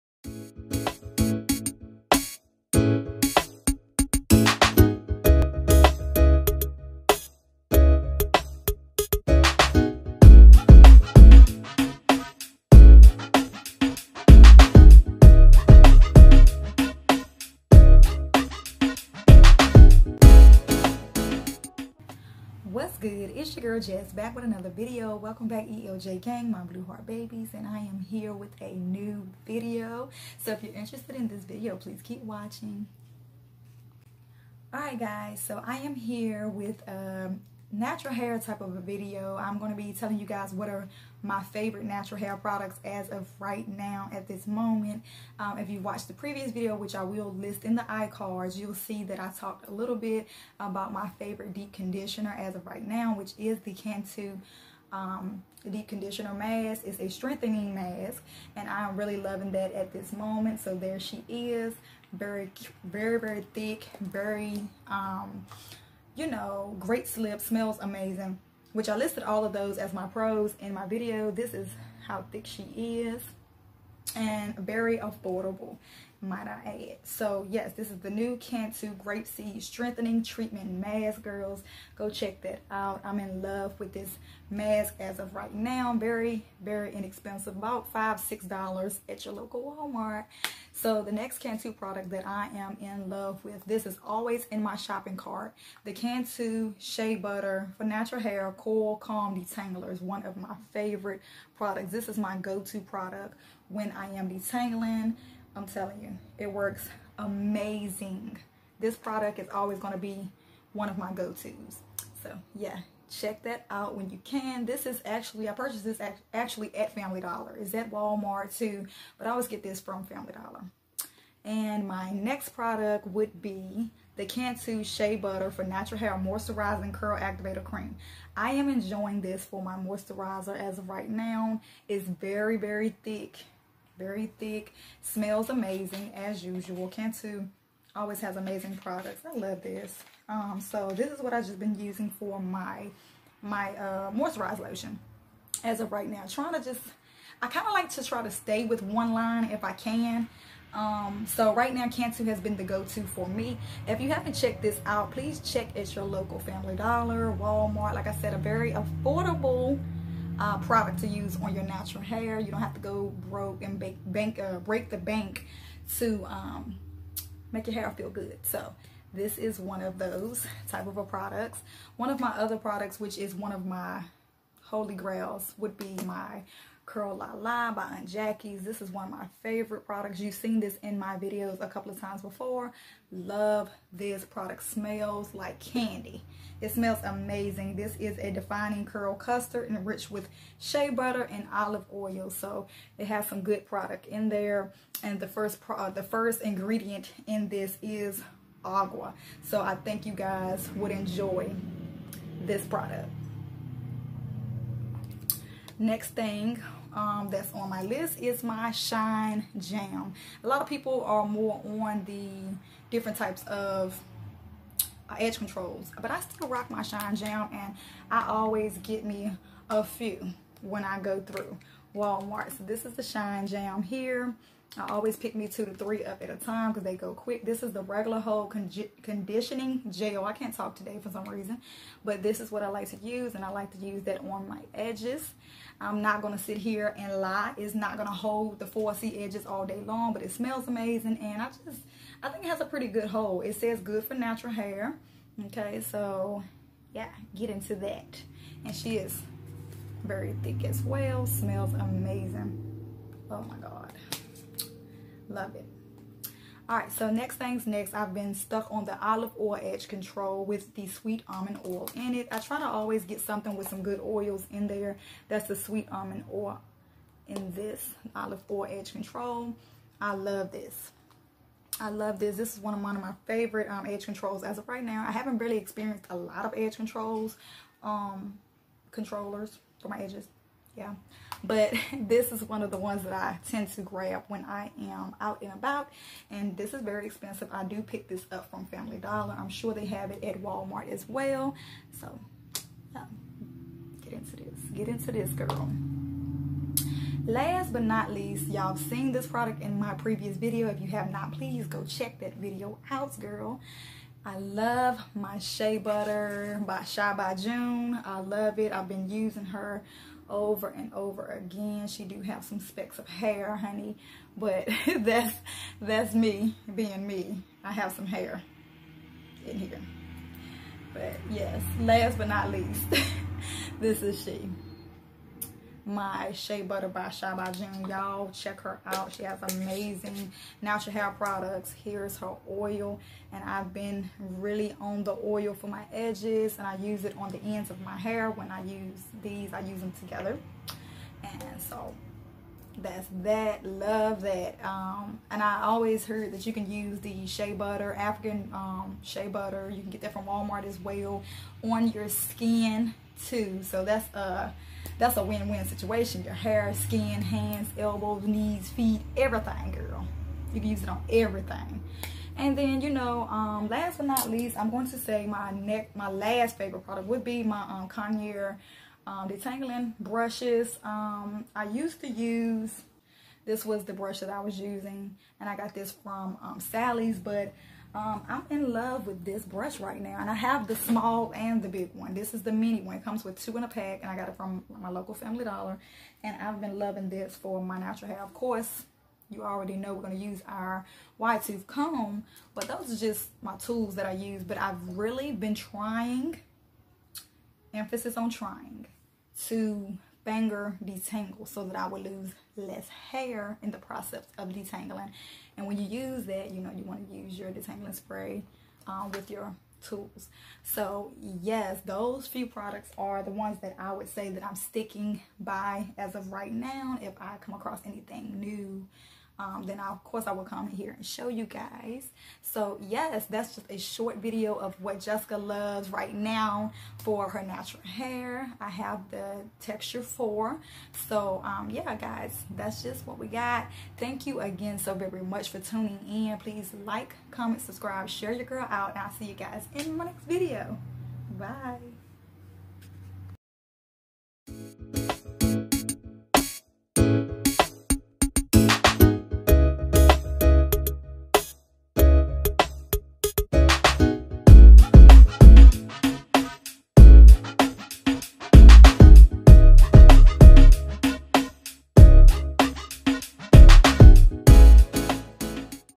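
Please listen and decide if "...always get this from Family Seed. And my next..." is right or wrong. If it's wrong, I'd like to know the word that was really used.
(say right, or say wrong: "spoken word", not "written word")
wrong: "Dollar", not "Seed".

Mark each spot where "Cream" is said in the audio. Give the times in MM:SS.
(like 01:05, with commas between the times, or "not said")
02:07.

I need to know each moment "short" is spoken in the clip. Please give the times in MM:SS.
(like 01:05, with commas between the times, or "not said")
07:03.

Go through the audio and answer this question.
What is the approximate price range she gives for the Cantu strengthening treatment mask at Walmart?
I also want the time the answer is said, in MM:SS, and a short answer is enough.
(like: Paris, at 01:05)
5-6 dollars, at 01:27.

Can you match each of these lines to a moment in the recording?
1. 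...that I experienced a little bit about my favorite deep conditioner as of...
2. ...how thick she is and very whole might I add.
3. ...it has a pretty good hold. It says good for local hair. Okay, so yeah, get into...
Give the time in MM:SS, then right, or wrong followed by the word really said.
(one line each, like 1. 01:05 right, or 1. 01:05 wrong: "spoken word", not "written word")
1. 00:49 wrong: "talked", not "experienced"
2. 01:12 wrong: "affordable", not "whole"
3. 04:02 wrong: "natural", not "local".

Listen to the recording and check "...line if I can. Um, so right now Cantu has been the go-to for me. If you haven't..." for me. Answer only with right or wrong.
right.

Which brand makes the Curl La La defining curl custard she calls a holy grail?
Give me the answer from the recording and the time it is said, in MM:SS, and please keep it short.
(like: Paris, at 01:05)
Aunt Jackie's, at 02:57.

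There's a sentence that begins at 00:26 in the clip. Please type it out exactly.
gang, my blue heart babies, and I am here with a new video.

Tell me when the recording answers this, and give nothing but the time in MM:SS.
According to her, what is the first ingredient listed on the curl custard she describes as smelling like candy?
03:18.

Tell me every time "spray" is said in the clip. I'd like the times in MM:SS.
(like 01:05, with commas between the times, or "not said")
06:47.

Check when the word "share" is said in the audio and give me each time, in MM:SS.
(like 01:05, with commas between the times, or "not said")
07:18.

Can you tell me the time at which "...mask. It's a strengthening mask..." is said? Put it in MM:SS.
00:56.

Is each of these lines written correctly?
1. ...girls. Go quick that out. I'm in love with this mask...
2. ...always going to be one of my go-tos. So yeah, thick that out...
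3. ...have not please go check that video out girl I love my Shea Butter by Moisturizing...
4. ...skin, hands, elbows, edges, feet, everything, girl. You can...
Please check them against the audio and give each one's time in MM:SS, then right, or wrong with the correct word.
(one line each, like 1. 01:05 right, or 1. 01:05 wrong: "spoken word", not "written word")
1. 01:21 wrong: "check", not "quick"
2. 01:49 wrong: "check", not "thick"
3. 05:00 wrong: "Shy", not "Moisturizing"
4. 05:56 wrong: "knees", not "edges".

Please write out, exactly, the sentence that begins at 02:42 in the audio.
You don't have to go broke and bake, bank, uh, break the bank to um, make your hair feel good.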